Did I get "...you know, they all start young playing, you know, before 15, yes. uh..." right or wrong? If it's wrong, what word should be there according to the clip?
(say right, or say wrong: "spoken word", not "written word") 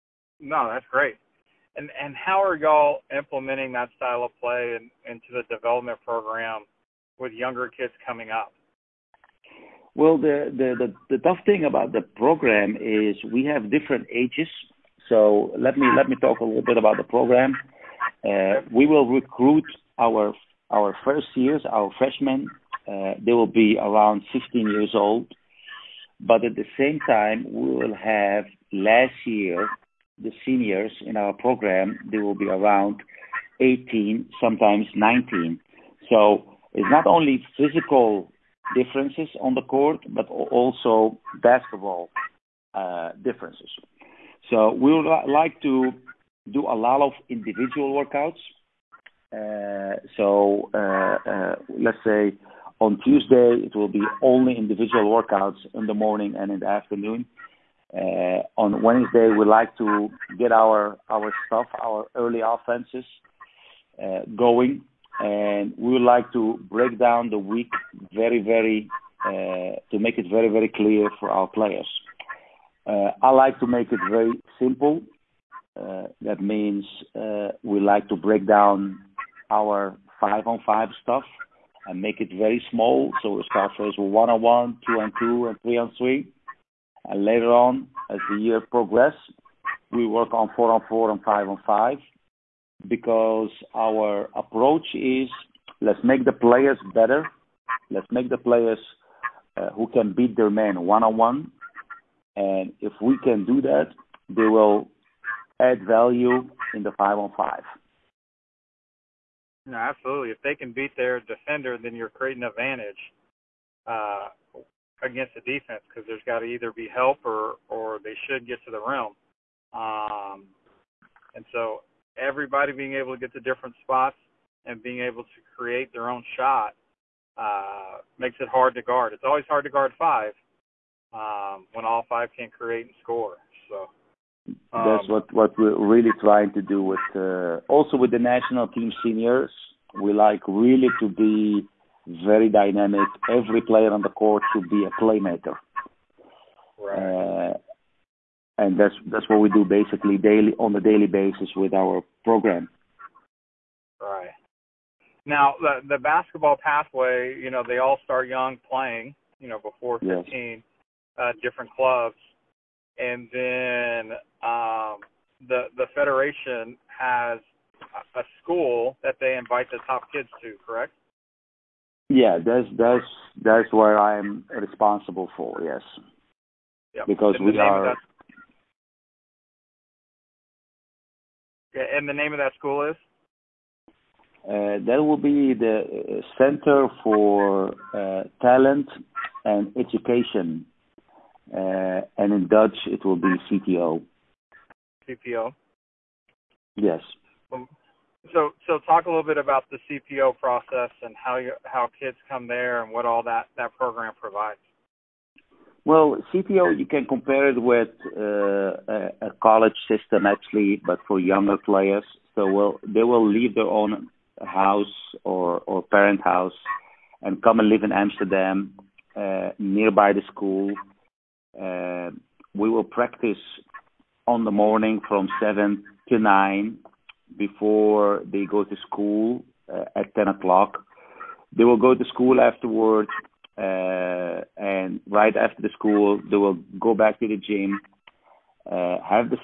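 right.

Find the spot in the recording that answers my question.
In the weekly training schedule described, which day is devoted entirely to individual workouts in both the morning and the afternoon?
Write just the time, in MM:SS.
00:53.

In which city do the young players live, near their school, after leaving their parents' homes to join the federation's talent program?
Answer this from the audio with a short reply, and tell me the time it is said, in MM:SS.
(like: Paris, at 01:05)
Amsterdam, at 03:37.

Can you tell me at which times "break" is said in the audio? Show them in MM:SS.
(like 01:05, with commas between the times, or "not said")
01:06, 01:18.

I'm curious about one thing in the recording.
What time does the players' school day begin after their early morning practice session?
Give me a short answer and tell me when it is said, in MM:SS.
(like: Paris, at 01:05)
10 o'clock, at 03:50.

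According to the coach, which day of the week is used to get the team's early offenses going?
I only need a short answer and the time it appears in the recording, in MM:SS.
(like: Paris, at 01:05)
Wednesday, at 00:58.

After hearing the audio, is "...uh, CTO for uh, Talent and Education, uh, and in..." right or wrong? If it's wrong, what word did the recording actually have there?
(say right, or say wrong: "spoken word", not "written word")
wrong: "Center", not "CTO".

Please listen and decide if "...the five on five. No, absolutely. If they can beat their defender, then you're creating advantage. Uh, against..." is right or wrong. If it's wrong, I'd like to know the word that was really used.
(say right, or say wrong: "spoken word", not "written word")
right.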